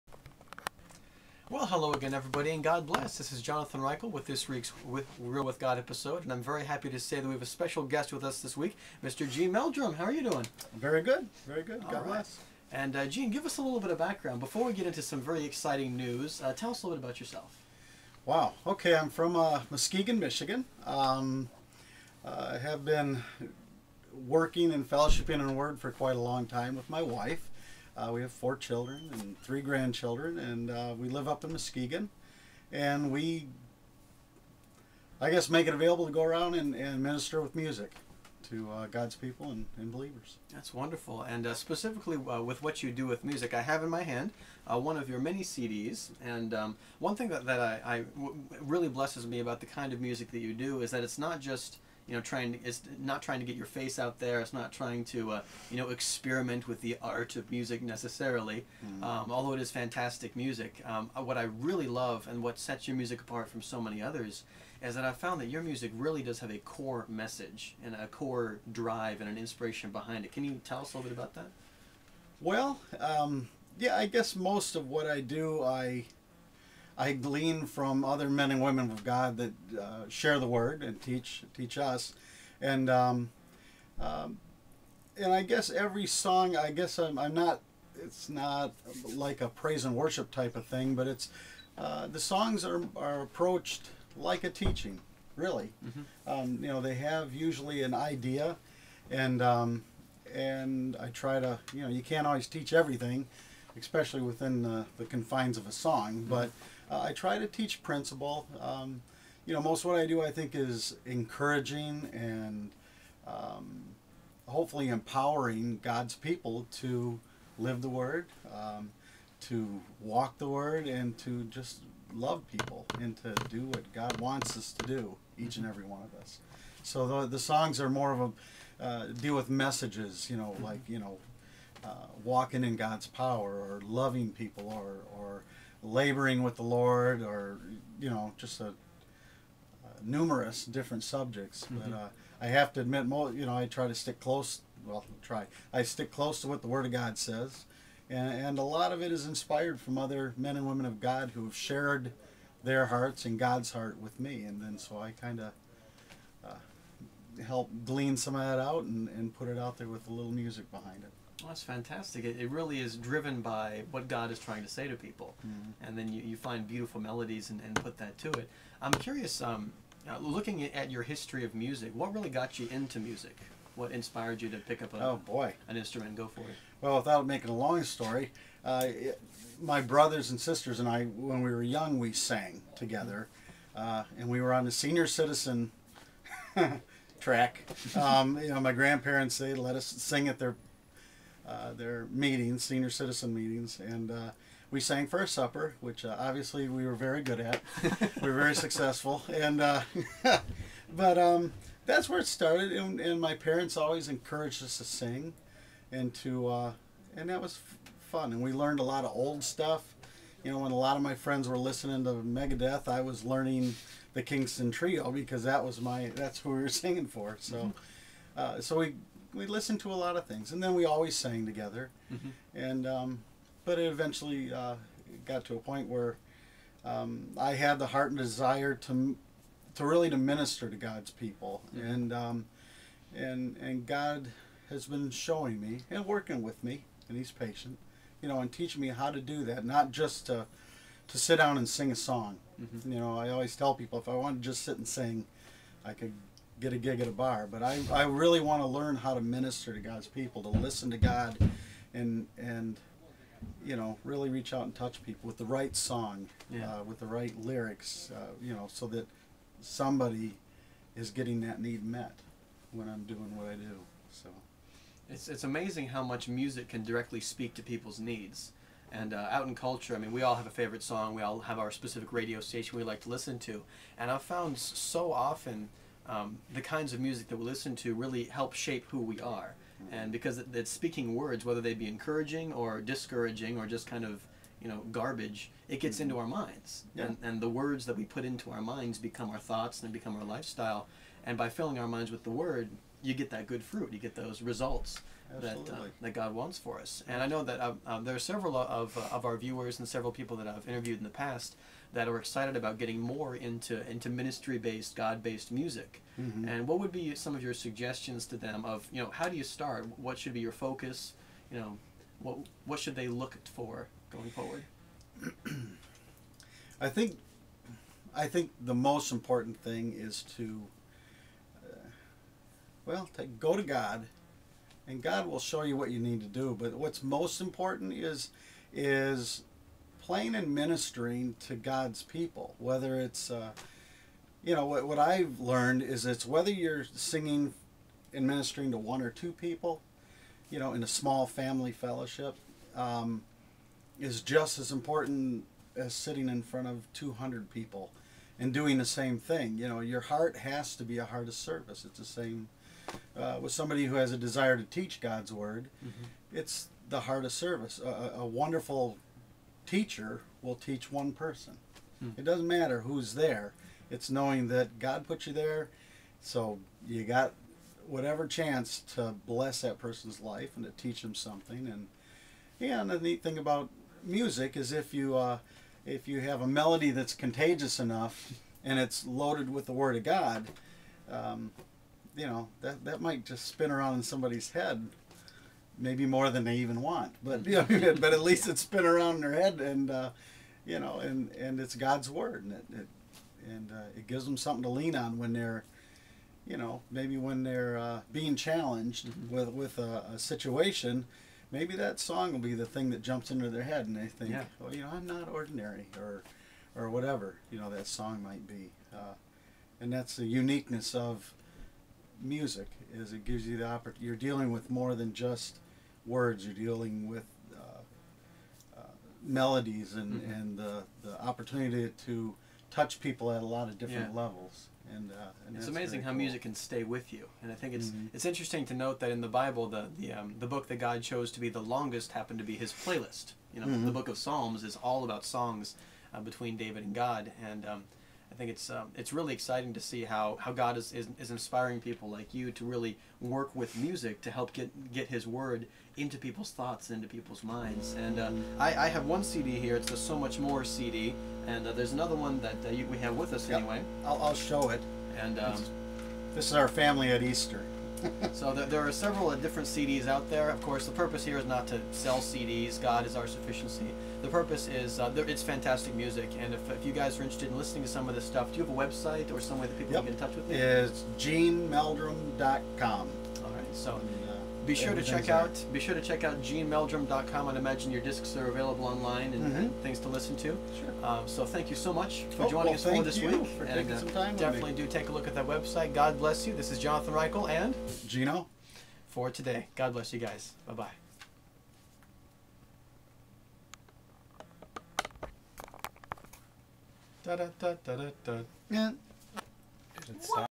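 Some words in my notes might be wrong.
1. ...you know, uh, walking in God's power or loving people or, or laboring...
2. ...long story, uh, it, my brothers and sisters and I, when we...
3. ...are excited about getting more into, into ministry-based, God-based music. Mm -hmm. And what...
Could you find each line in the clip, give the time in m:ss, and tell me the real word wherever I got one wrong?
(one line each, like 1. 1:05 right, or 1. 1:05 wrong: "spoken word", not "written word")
1. 2:10 right
2. 2:57 right
3. 5:02 right.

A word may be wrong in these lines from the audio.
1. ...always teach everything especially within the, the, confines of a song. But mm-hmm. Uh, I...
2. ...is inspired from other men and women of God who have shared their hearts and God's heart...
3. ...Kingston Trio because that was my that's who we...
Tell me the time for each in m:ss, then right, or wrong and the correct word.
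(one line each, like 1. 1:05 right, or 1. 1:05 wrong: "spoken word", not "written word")
1. 1:42 right
2. 2:29 right
3. 3:34 right.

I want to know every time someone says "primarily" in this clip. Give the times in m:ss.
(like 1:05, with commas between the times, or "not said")
not said.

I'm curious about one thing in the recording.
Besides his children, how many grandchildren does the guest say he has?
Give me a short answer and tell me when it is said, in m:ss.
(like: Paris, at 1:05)
3, at 0:29.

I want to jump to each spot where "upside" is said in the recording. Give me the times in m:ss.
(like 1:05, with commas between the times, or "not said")
not said.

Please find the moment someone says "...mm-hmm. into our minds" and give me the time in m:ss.
4:45.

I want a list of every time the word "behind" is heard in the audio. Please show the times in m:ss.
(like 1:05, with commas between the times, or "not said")
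1:09, 2:40.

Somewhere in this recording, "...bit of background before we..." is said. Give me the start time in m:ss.
0:13.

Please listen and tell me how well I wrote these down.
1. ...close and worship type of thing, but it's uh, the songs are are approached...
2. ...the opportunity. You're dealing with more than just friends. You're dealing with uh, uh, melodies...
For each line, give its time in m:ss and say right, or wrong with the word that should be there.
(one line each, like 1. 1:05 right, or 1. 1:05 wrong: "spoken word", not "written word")
1. 1:29 wrong: "praise", not "close"
2. 6:53 wrong: "words", not "friends".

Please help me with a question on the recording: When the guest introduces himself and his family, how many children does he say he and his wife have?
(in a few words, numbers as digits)
4.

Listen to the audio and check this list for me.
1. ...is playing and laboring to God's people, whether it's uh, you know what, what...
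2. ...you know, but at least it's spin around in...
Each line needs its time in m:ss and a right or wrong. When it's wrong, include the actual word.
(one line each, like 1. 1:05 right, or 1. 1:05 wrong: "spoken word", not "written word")
1. 5:28 wrong: "ministering", not "laboring"
2. 6:27 right.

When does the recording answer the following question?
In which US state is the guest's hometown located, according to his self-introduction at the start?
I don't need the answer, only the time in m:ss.
0:20.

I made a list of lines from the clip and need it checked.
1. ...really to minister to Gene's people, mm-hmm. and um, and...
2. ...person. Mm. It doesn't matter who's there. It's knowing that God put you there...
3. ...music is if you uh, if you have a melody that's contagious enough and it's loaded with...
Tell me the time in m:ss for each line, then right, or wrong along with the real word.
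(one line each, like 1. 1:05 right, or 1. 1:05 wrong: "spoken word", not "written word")
1. 3:49 wrong: "God", not "Gene"
2. 6:01 right
3. 6:14 right.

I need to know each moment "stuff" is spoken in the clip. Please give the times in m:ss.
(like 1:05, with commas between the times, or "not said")
3:29, 7:48.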